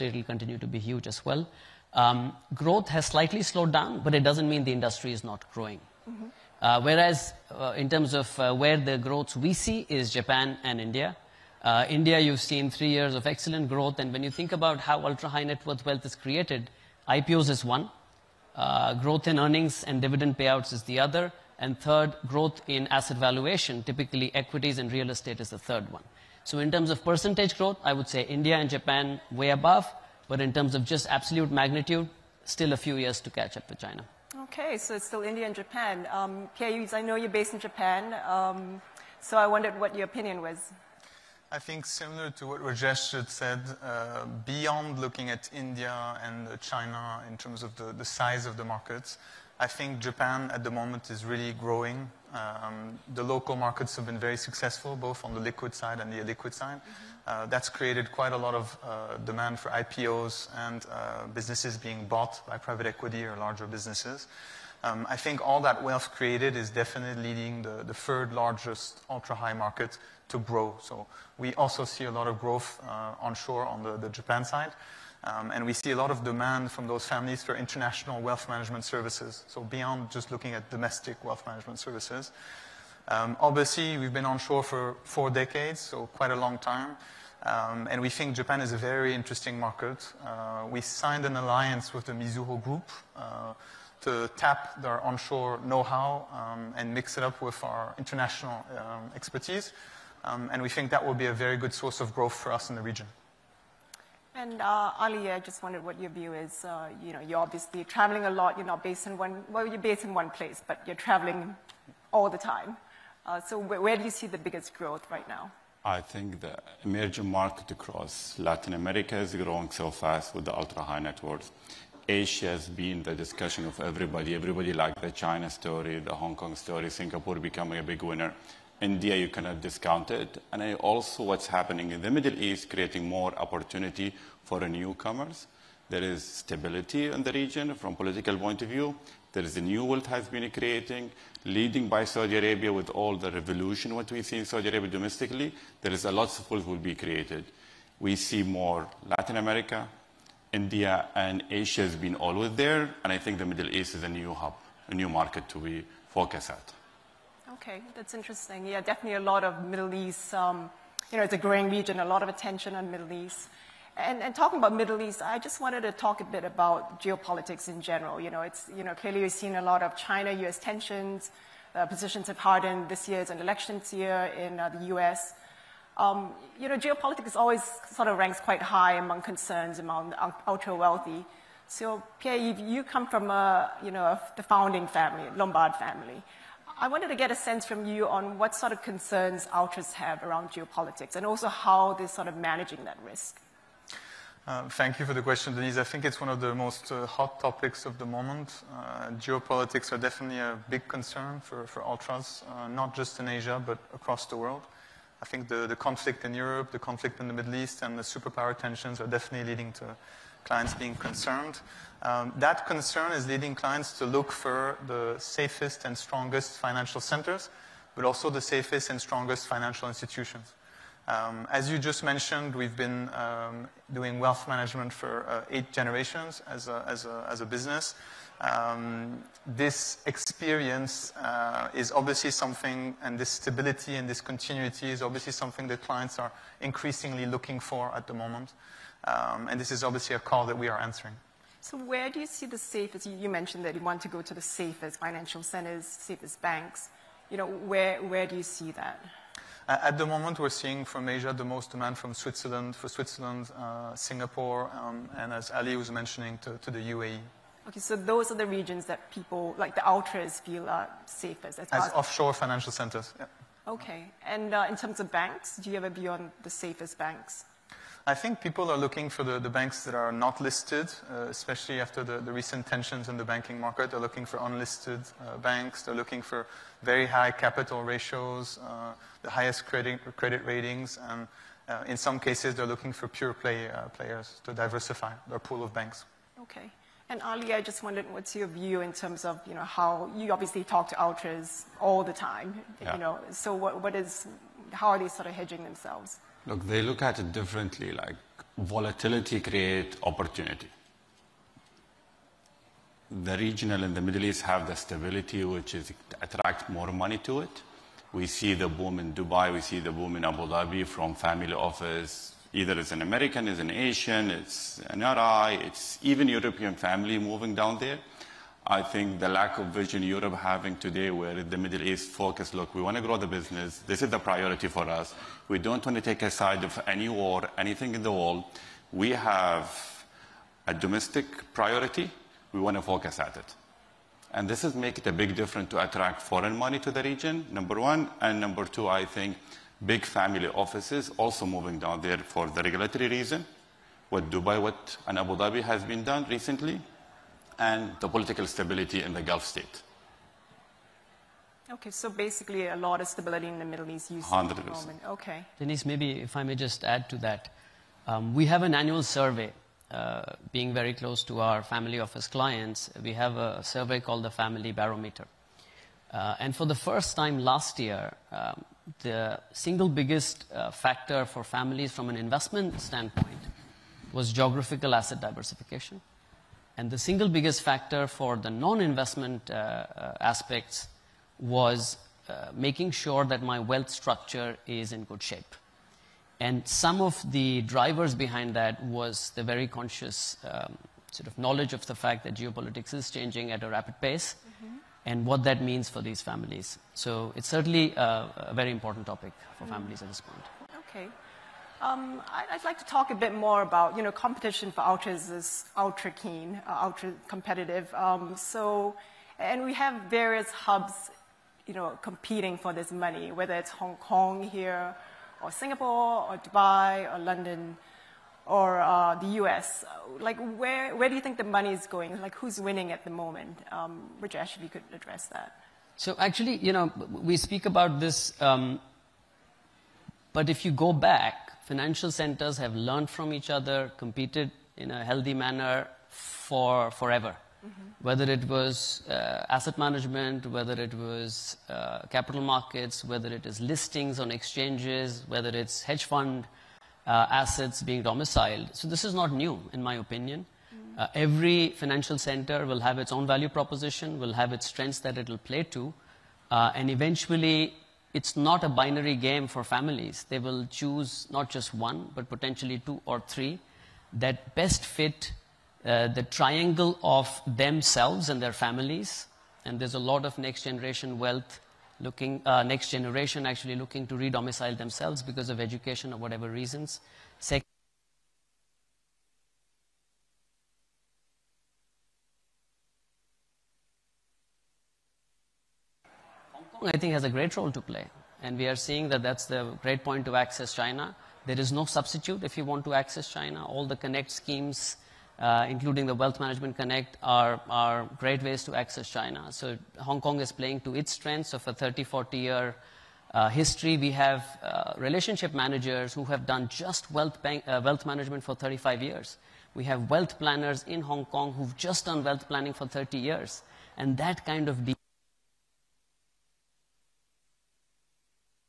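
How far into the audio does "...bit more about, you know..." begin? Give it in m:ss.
6:43.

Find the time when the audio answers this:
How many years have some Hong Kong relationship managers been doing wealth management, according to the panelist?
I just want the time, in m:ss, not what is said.
8:28.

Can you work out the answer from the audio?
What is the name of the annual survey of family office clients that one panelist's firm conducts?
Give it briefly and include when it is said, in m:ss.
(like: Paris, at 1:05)
Family Barometer, at 6:04.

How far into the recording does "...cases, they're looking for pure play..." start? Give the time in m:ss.
4:42.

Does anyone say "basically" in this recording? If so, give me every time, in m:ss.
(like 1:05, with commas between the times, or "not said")
5:52.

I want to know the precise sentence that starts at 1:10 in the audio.
So we also see a lot of growth uh, onshore on the, the Japan side.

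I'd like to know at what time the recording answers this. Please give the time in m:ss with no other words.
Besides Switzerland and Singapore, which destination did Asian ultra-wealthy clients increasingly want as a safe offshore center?
4:16.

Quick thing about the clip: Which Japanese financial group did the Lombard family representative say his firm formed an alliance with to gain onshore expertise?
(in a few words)
Mizuho Group.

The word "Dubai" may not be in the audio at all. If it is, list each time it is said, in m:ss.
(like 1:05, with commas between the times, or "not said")
5:09, 5:44, 6:56.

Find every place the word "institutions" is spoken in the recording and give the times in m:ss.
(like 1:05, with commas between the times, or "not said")
3:39.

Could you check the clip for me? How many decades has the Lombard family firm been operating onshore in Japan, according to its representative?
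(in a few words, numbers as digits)
4.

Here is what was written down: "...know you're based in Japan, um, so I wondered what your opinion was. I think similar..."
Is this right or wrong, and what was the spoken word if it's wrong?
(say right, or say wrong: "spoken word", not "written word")
right.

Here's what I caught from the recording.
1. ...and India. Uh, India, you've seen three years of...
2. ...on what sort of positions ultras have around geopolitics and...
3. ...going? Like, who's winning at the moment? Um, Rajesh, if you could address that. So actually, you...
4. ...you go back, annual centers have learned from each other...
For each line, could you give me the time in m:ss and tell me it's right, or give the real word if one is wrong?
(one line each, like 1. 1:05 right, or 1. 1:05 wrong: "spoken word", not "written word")
1. 0:10 right
2. 3:08 wrong: "concerns", not "positions"
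3. 7:01 right
4. 7:10 wrong: "financial", not "annual".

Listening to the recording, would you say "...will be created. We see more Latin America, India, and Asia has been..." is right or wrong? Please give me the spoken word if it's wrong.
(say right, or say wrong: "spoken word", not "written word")
right.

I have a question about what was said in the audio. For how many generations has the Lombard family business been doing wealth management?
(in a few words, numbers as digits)
8.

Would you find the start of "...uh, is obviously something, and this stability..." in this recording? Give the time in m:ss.
3:51.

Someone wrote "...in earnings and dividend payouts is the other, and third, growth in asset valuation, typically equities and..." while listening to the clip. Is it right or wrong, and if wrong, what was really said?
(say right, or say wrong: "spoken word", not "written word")
right.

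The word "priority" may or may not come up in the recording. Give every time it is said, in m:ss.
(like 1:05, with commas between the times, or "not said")
5:24, 5:31.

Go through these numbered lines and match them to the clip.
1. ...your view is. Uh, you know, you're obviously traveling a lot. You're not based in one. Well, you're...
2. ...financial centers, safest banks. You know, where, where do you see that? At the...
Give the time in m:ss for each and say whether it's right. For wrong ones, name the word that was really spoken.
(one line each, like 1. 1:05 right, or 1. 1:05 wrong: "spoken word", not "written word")
1. 1:45 right
2. 4:04 right.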